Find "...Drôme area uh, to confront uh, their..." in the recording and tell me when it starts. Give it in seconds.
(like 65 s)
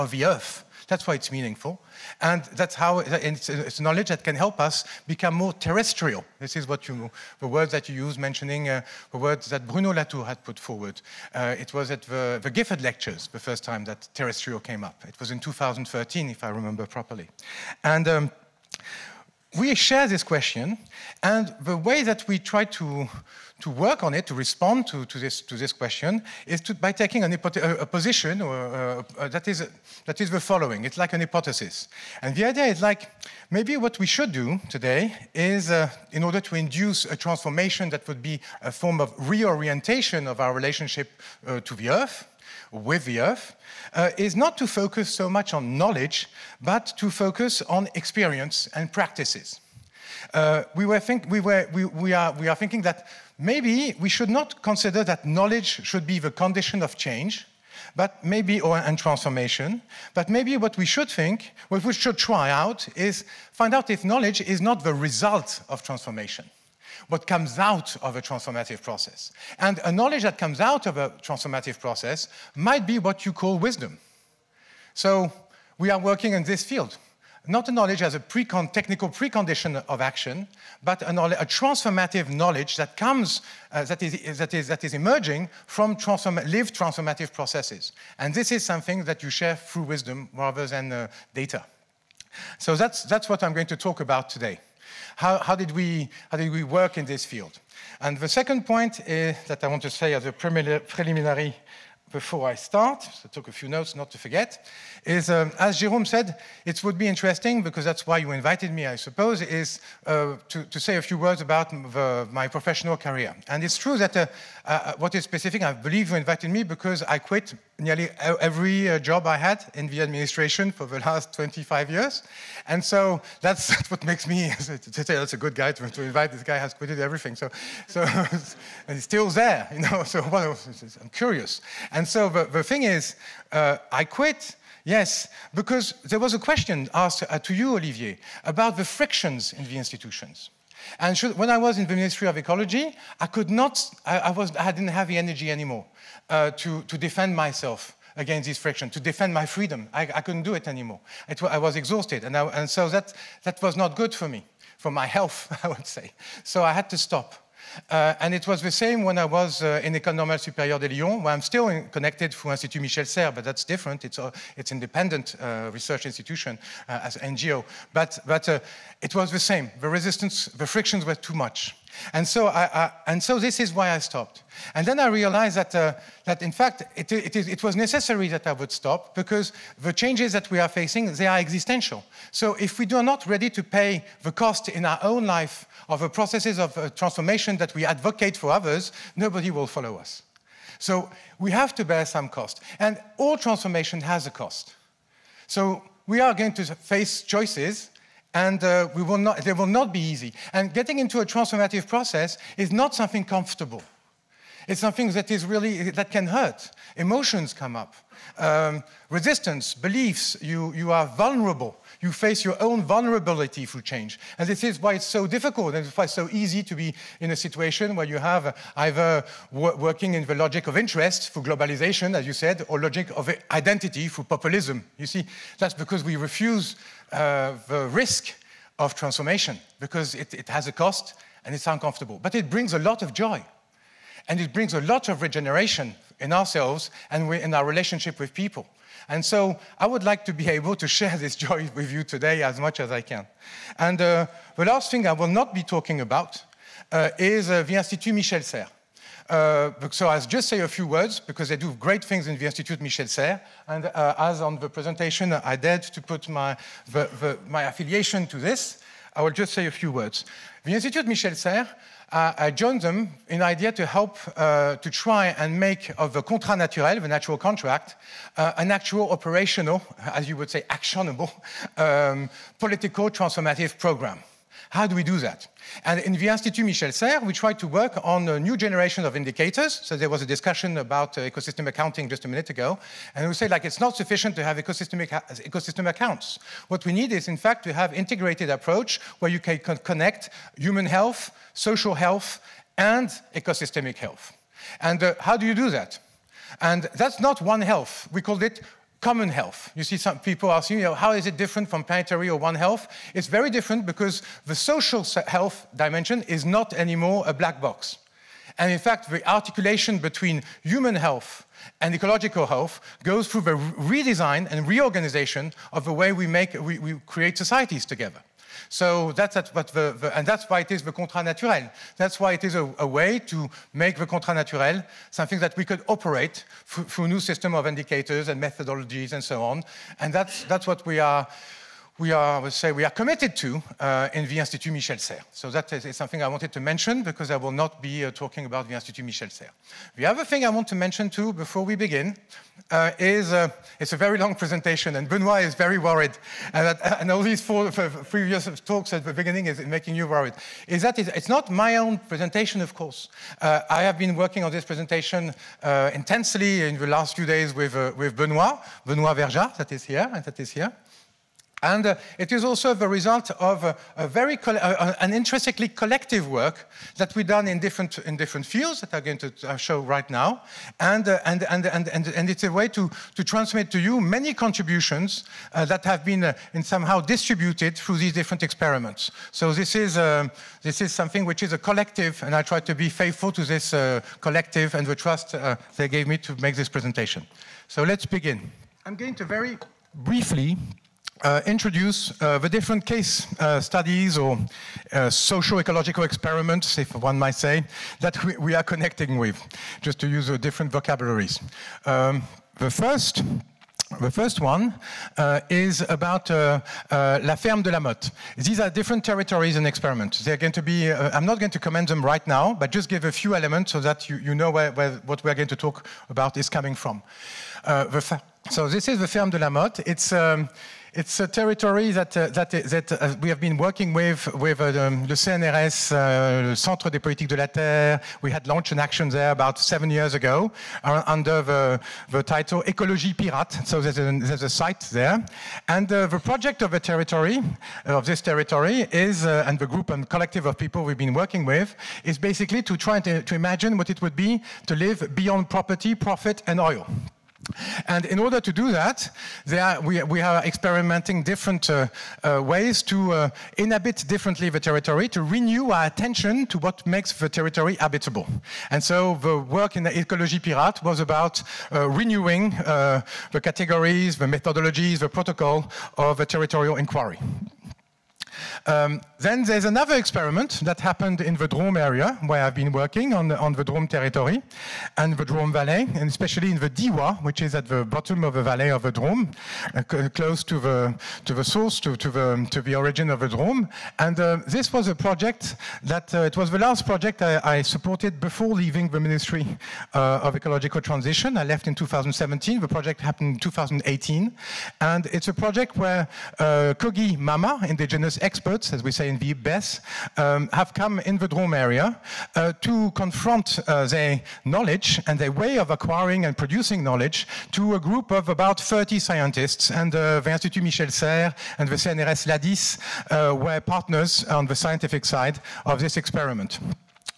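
501 s.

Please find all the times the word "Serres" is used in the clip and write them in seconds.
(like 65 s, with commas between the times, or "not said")
163 s, 248 s, 253 s, 261 s, 276 s, 334 s, 339 s, 510 s.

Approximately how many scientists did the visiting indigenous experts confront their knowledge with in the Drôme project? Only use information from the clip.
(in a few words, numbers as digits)
30.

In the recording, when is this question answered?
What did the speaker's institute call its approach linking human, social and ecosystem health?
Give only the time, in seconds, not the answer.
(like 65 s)
299 s.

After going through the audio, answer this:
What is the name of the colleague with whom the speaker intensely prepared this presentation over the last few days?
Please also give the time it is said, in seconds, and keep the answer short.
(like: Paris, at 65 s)
Benoit Verja, at 358 s.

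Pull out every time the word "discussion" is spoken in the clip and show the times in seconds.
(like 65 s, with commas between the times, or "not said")
280 s.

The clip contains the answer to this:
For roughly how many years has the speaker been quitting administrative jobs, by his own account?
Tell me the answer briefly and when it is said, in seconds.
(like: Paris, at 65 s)
25 years, at 121 s.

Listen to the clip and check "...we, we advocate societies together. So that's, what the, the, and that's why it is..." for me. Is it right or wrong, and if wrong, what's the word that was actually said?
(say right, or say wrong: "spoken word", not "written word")
wrong: "create", not "advocate".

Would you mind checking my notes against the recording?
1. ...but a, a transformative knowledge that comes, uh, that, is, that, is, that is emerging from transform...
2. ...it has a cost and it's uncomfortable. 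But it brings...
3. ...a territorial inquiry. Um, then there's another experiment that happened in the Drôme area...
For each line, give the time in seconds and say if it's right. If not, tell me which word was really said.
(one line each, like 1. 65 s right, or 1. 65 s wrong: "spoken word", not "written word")
1. 80 s right
2. 230 s right
3. 466 s right.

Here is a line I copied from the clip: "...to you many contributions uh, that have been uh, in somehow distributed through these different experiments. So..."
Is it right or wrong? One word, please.
right.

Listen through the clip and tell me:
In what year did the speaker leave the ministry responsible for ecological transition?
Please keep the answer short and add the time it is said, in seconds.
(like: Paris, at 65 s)
2017, at 491 s.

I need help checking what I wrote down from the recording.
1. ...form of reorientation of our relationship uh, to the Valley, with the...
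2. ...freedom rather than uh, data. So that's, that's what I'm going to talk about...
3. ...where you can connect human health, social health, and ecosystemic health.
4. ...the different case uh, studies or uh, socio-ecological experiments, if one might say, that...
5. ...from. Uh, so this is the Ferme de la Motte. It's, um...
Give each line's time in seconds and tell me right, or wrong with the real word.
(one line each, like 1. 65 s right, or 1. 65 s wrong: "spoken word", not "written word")
1. 38 s wrong: "Earth", not "Valley"
2. 89 s wrong: "wisdom", not "freedom"
3. 289 s right
4. 392 s right
5. 416 s right.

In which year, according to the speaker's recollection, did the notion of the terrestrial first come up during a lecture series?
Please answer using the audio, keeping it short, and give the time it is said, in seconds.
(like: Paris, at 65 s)
2013, at 15 s.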